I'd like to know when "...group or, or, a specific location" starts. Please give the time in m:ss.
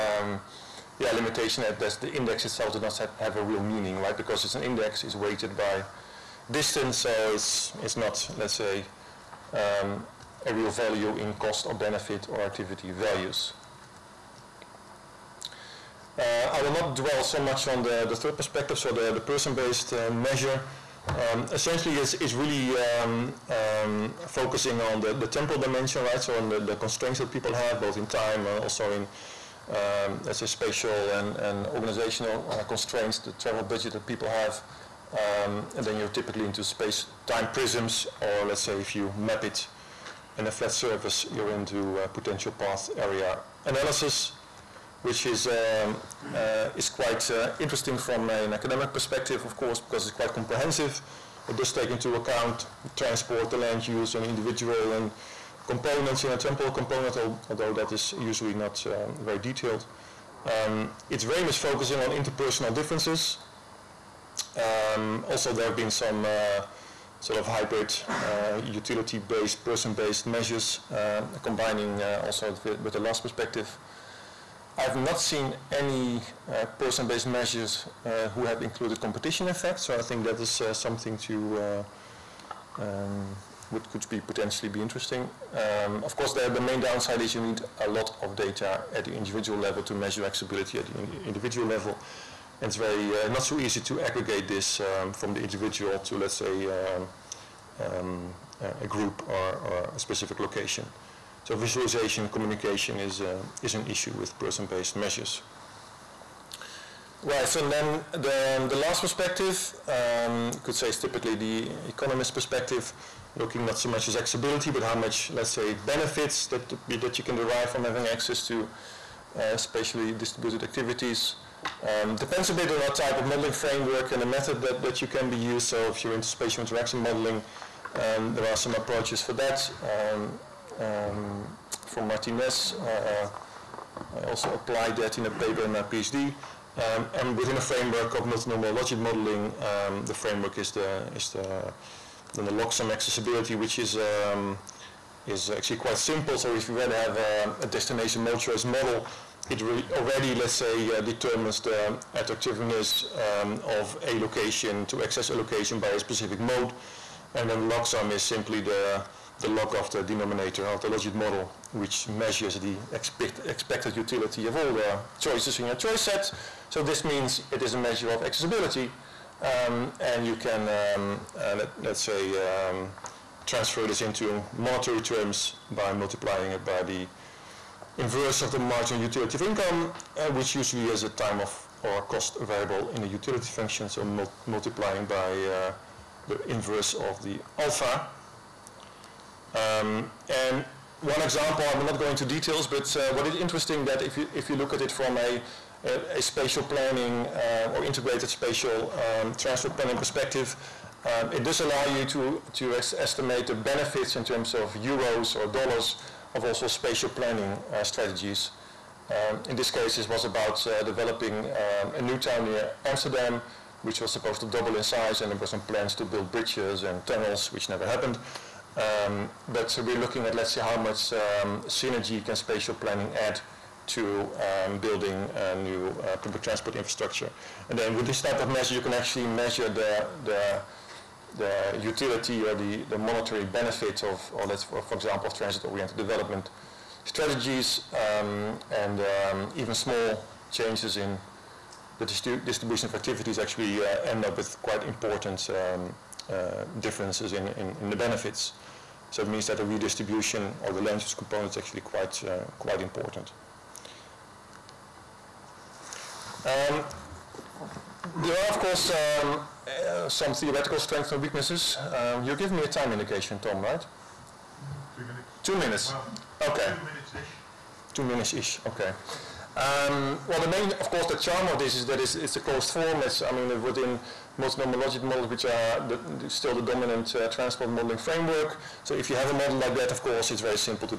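1:38.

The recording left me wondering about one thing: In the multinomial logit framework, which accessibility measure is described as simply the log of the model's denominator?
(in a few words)
Logsum accessibility.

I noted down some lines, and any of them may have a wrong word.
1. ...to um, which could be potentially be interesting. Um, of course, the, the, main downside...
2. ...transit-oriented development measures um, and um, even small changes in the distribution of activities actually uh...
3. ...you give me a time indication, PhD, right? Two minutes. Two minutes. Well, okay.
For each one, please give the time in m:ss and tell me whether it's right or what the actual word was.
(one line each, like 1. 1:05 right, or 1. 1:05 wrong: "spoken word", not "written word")
1. 1:21 right
2. 3:55 wrong: "strategies", not "measures"
3. 4:22 wrong: "Tom", not "PhD".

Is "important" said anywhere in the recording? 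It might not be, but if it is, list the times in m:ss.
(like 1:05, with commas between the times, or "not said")
4:04, 4:12.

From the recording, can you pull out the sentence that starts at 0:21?
Um, essentially, it's, it's really um, um, focusing on the, the temporal dimension, right?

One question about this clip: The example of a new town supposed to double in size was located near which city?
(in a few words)
Amsterdam.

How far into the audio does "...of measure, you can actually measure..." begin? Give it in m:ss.
3:48.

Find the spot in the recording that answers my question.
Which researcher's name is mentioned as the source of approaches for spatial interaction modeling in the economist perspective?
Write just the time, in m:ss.
2:12.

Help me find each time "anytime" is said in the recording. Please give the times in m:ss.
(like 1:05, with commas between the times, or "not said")
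not said.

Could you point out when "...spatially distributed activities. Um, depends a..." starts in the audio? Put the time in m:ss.
1:59.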